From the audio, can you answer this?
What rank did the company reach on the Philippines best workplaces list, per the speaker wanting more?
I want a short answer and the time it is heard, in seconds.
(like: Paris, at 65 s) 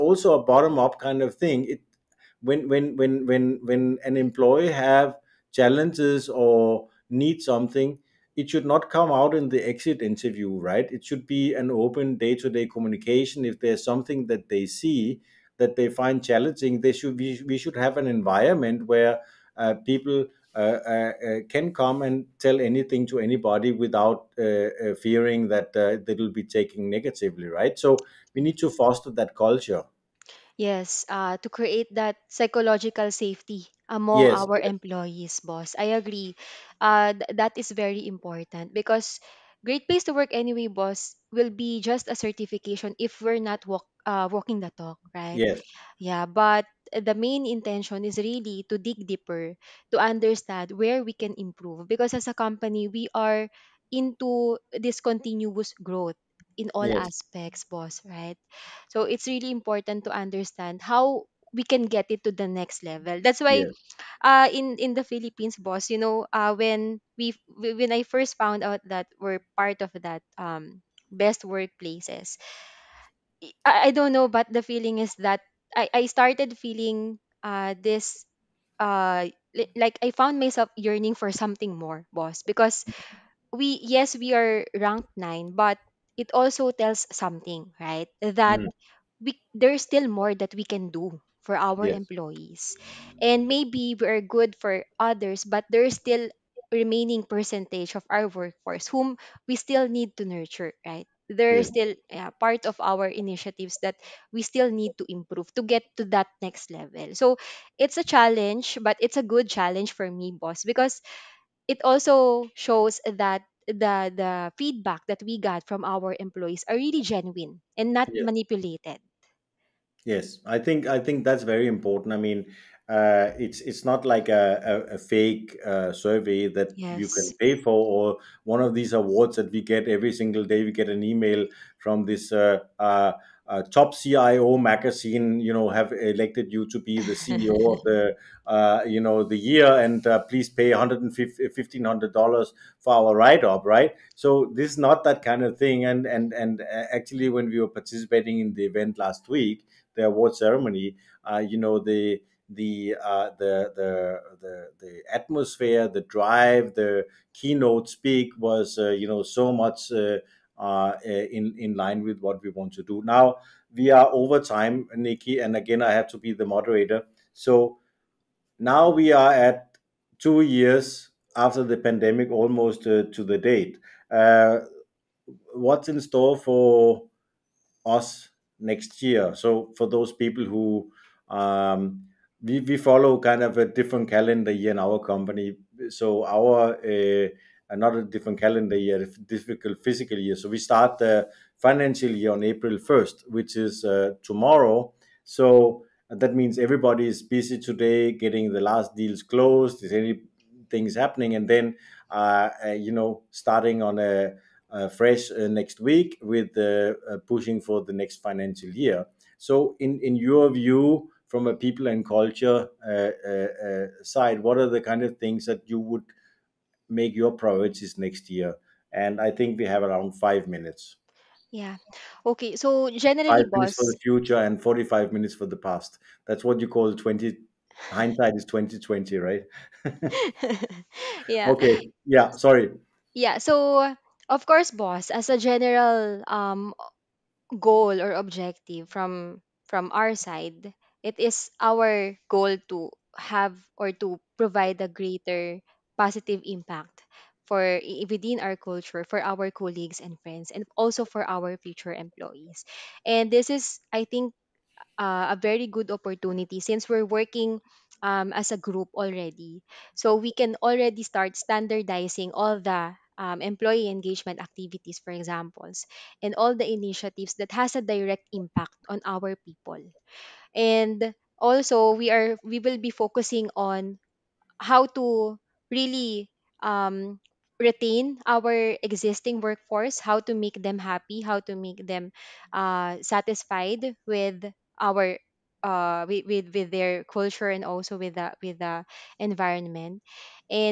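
9, at 85 s.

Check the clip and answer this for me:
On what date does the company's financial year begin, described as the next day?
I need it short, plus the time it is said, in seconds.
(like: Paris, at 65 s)
April 1st, at 192 s.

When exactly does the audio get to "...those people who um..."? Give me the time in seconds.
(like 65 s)
179 s.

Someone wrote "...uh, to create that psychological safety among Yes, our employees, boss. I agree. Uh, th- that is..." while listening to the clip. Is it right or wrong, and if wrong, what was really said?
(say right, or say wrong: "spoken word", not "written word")
right.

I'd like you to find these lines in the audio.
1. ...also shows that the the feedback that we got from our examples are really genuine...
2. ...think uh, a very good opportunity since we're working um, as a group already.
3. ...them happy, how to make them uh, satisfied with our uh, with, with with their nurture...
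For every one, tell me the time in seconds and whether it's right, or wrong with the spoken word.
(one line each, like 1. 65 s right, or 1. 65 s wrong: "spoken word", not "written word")
1. 111 s wrong: "employees", not "examples"
2. 254 s right
3. 280 s wrong: "culture", not "nurture".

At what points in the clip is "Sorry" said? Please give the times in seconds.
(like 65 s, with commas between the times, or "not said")
232 s.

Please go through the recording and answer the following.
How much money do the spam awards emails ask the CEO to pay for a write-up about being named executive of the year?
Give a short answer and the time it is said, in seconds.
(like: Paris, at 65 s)
$1500, at 140 s.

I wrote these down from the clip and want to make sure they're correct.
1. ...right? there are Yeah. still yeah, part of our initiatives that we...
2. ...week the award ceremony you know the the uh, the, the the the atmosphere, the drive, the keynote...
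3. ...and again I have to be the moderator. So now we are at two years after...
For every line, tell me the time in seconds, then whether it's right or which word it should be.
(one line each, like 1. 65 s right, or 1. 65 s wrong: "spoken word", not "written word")
1. 100 s right
2. 149 s right
3. 165 s right.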